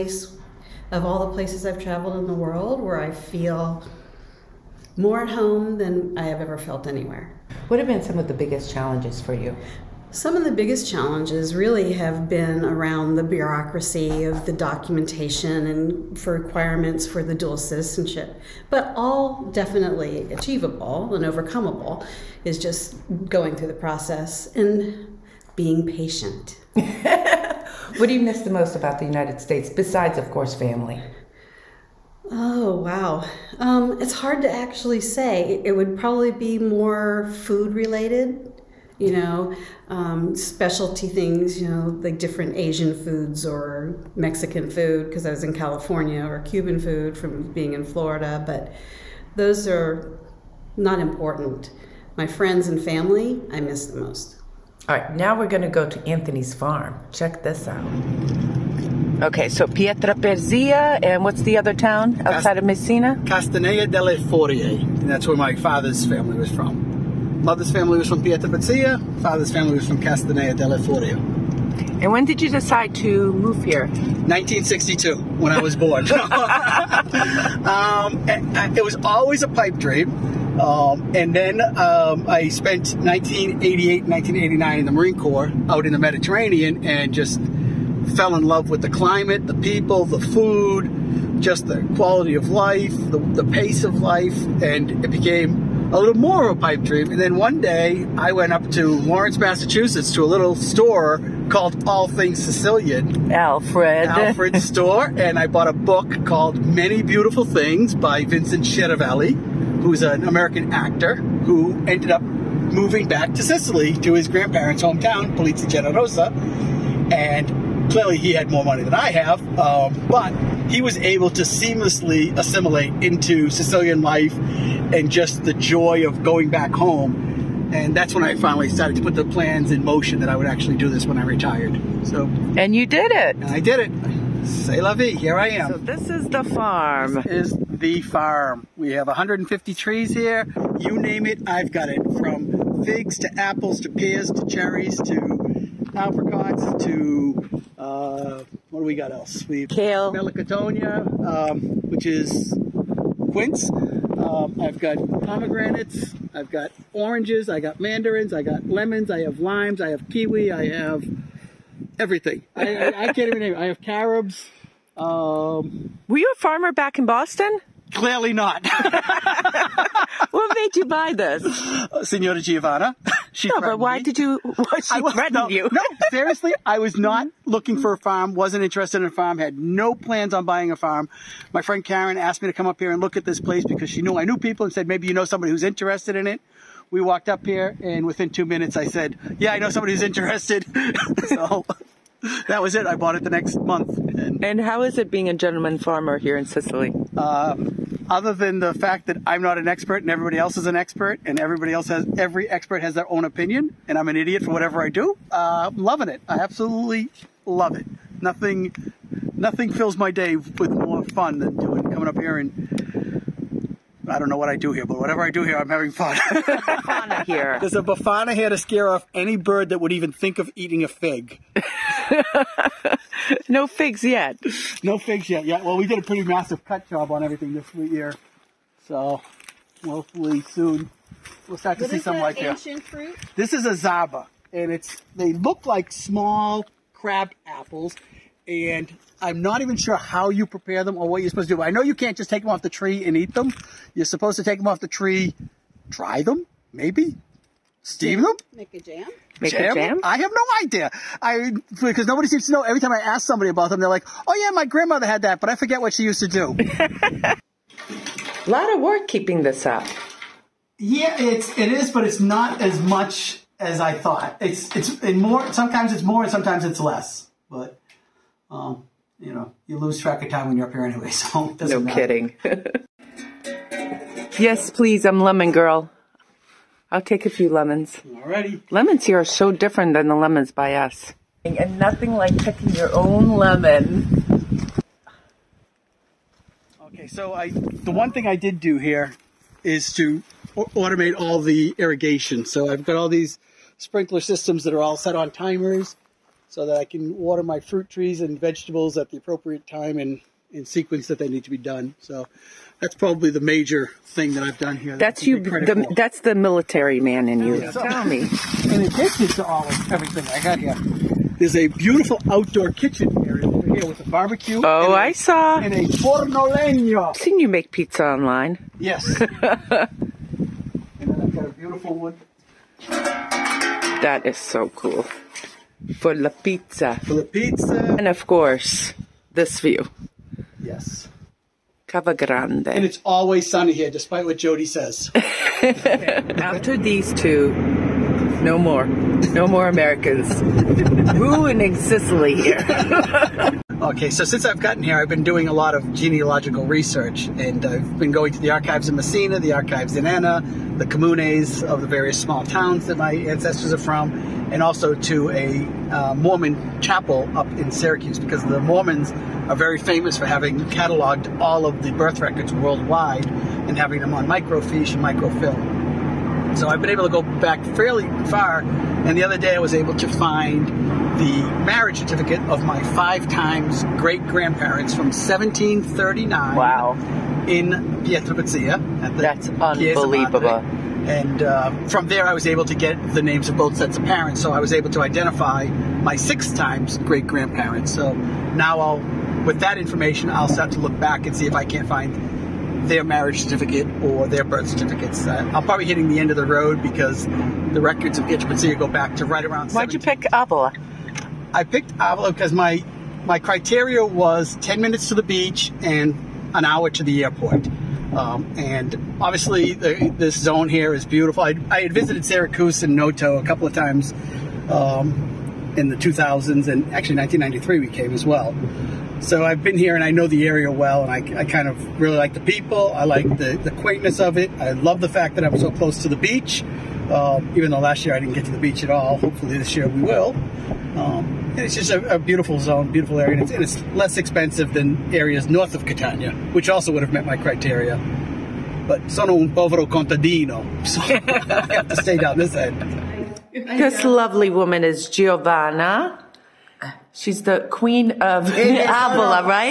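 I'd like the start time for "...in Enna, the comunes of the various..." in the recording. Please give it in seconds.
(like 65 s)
349 s.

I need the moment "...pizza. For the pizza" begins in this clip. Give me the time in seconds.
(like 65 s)
326 s.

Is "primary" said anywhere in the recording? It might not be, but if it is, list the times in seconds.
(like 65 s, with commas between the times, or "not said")
not said.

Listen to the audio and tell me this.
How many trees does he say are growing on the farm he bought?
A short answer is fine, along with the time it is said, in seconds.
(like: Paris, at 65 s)
150, at 139 s.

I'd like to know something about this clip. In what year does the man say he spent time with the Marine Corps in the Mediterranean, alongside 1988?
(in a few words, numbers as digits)
1989.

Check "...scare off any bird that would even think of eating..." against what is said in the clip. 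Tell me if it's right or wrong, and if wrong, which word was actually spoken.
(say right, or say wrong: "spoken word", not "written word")
right.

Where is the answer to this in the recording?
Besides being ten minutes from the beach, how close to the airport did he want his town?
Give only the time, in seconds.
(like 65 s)
406 s.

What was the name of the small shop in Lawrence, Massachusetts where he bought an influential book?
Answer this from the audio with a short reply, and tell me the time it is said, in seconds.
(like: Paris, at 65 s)
All Things Sicilian, at 101 s.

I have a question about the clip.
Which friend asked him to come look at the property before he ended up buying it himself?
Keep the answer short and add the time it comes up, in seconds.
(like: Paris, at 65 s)
Karen, at 181 s.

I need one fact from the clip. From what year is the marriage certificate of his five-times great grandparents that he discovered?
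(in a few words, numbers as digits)
1739.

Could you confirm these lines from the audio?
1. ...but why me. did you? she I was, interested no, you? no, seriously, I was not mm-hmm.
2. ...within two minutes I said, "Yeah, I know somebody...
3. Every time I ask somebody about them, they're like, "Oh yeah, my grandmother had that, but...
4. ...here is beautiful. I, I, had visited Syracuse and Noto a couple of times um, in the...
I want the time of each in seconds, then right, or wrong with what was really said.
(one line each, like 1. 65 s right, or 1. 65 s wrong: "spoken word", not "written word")
1. 173 s wrong: "threatened", not "interested"
2. 188 s right
3. 252 s right
4. 410 s right.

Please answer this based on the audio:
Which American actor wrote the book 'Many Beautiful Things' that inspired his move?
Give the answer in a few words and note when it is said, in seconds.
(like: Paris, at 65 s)
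Vincent Schiavelli, at 108 s.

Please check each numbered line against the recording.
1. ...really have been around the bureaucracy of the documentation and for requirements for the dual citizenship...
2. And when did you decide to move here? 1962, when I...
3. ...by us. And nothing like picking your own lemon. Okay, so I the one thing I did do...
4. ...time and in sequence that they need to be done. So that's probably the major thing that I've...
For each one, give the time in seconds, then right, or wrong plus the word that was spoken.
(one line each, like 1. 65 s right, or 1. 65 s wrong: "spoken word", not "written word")
1. 11 s right
2. 72 s right
3. 280 s right
4. 299 s right.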